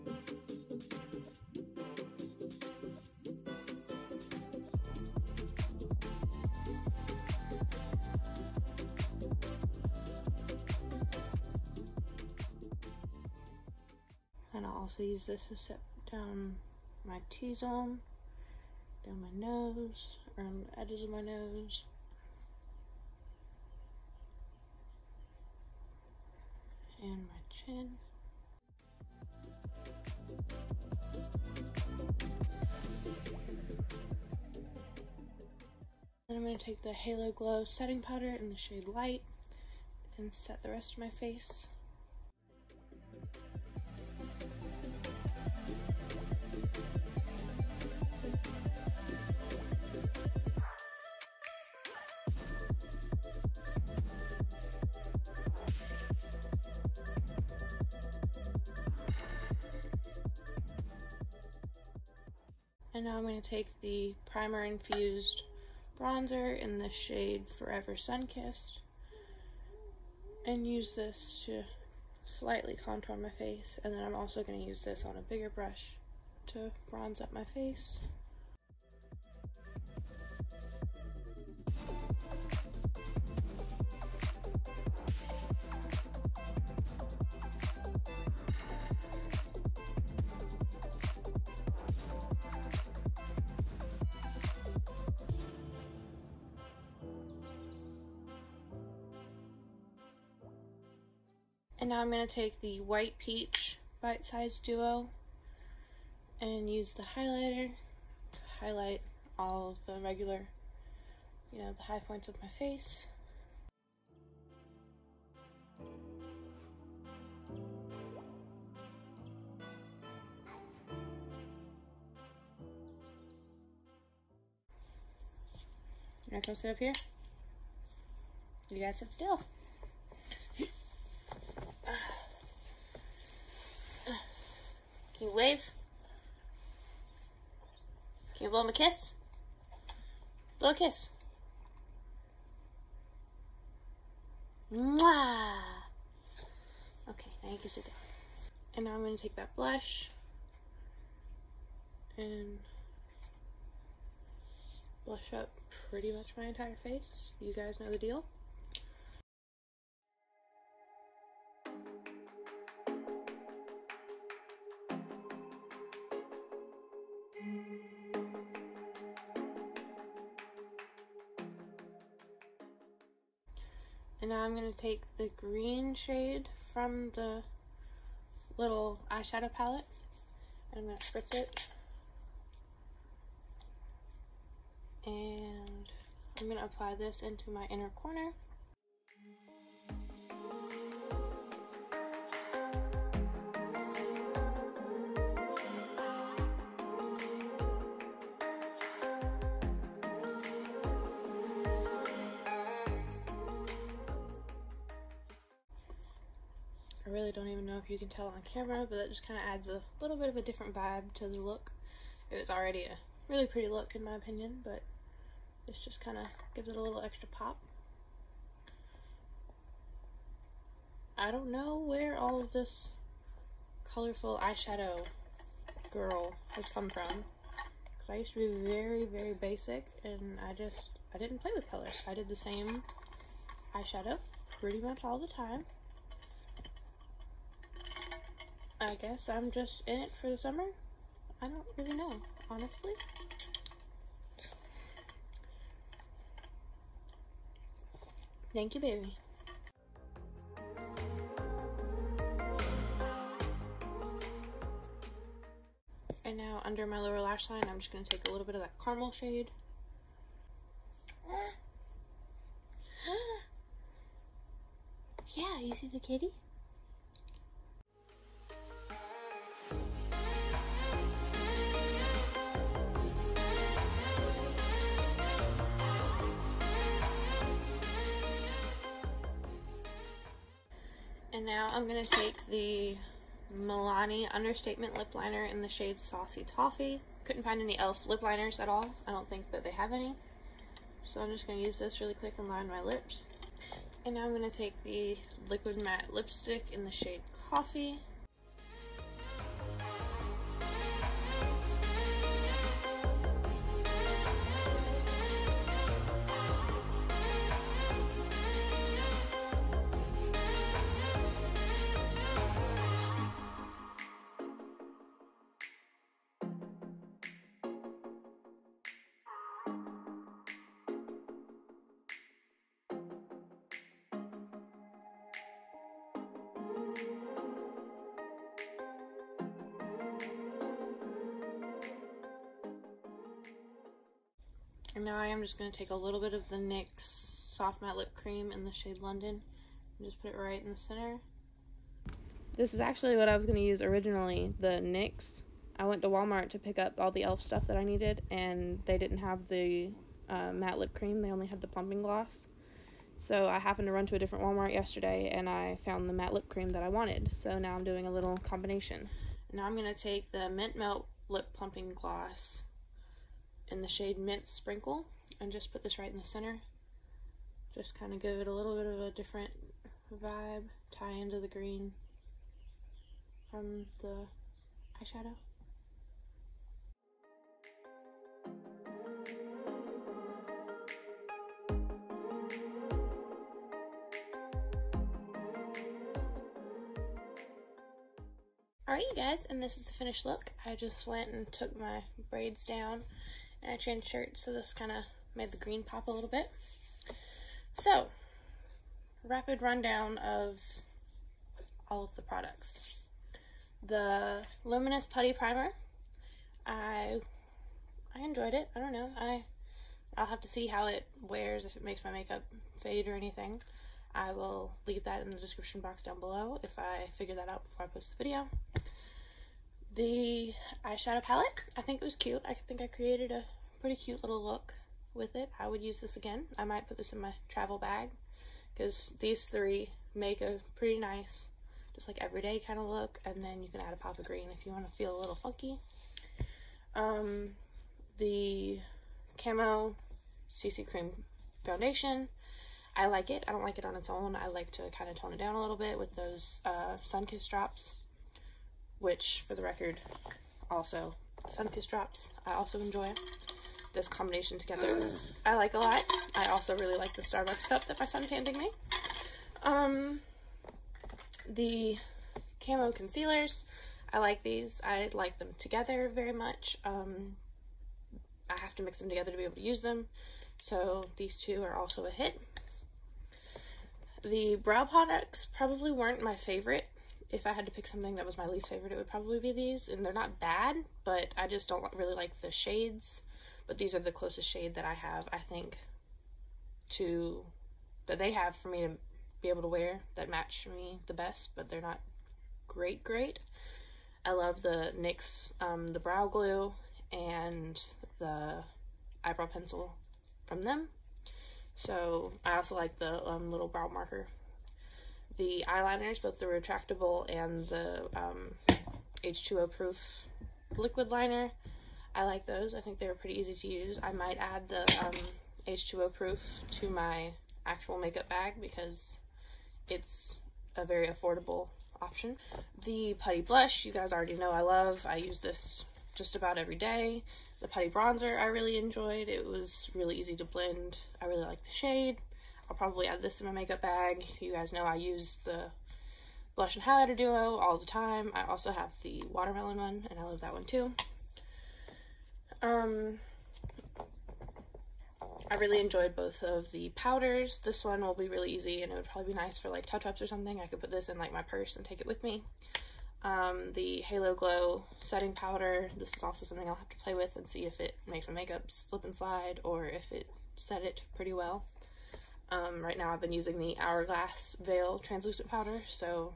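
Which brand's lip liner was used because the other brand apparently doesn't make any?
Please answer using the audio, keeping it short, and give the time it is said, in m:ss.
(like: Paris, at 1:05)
Milani, at 4:43.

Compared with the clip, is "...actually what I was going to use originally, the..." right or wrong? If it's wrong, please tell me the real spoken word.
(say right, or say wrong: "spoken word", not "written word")
right.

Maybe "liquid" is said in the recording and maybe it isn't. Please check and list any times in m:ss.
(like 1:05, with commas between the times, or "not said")
4:55, 8:30.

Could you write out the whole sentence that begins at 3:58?
I guess I'm just in it for the summer.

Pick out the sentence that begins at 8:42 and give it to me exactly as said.
The Putty Blush, you guys already know I love.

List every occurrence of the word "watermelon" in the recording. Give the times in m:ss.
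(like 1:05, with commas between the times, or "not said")
8:59.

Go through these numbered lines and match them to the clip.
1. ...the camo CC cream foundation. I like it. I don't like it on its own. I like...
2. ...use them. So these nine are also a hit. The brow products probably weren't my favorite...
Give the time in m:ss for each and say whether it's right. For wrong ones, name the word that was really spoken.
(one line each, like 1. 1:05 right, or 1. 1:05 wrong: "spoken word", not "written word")
1. 7:18 right
2. 7:49 wrong: "two", not "nine".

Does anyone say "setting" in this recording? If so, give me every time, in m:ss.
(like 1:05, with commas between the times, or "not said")
0:37, 9:14.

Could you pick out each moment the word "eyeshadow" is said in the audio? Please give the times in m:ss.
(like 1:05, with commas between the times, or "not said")
2:59, 3:44, 3:53, 6:15, 7:00.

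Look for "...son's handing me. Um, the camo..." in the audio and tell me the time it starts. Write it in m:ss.
7:38.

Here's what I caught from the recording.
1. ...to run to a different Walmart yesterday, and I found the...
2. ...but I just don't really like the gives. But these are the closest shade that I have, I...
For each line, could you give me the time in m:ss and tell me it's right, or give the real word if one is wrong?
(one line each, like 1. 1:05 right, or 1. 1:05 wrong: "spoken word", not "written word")
1. 5:53 right
2. 8:01 wrong: "shades", not "gives".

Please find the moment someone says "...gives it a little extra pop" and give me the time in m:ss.
3:36.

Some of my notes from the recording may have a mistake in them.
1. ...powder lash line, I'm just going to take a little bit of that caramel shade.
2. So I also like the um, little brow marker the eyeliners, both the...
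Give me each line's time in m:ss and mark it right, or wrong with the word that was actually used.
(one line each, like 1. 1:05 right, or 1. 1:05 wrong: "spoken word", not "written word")
1. 4:16 wrong: "lower", not "powder"
2. 8:21 right.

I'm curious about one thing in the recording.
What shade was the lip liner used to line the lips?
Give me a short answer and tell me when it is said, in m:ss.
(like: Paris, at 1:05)
Saucy Toffee, at 4:46.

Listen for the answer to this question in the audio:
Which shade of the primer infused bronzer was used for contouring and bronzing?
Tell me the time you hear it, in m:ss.
1:07.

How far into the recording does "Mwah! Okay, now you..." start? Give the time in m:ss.
2:24.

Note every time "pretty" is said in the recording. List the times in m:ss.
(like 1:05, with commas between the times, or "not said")
2:35, 3:33, 3:54, 7:03, 7:10, 8:33, 9:21.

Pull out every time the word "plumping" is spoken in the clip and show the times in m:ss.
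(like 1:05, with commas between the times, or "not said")
5:51, 6:01.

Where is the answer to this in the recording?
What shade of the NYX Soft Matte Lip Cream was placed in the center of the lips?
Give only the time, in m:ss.
5:39.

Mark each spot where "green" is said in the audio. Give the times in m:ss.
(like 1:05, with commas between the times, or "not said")
2:55, 6:11, 6:35, 7:14.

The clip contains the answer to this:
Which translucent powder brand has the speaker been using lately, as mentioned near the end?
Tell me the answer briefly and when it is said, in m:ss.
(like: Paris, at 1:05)
Hourglass, at 9:23.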